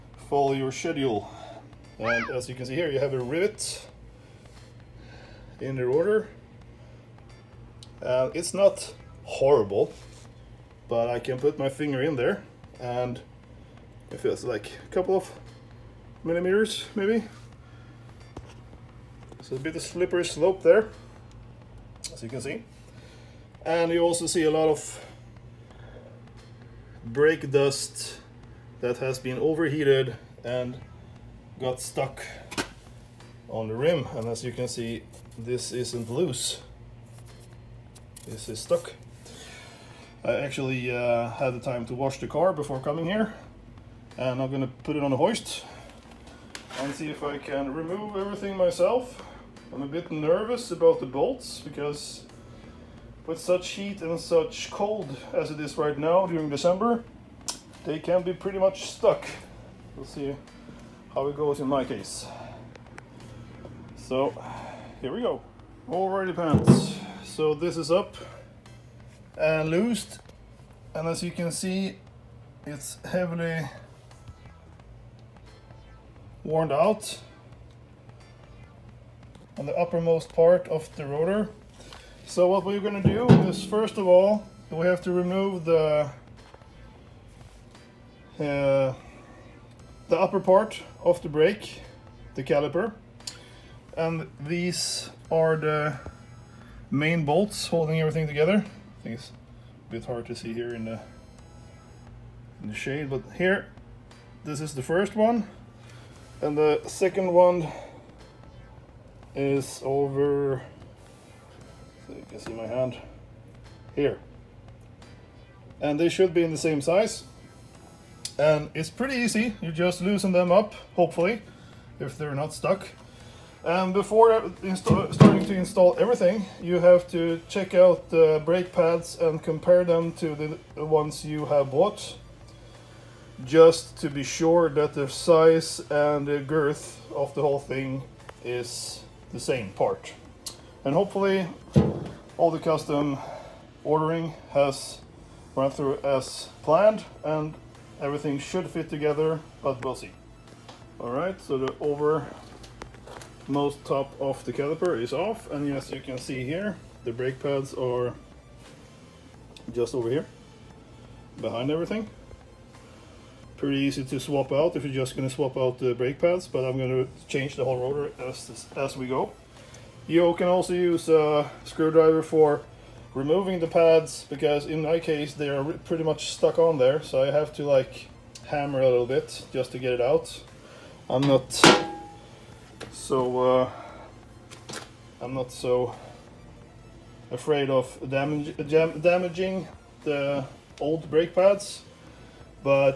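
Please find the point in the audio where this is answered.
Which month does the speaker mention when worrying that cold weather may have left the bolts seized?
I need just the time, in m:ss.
0:56.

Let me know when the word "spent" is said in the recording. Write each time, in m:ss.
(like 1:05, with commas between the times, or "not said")
not said.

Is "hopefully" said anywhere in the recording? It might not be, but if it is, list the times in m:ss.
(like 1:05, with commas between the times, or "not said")
2:00, 2:20.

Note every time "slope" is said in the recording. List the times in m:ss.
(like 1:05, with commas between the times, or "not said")
0:20.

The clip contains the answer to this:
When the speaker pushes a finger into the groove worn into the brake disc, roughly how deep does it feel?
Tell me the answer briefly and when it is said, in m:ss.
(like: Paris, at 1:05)
A couple of millimeters, at 0:14.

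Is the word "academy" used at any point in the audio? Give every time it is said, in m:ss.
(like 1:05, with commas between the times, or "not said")
not said.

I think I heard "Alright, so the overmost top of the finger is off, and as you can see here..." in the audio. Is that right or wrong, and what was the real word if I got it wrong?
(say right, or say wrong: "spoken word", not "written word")
wrong: "caliper", not "finger".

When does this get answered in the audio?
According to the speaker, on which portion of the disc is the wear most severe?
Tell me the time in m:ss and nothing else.
1:19.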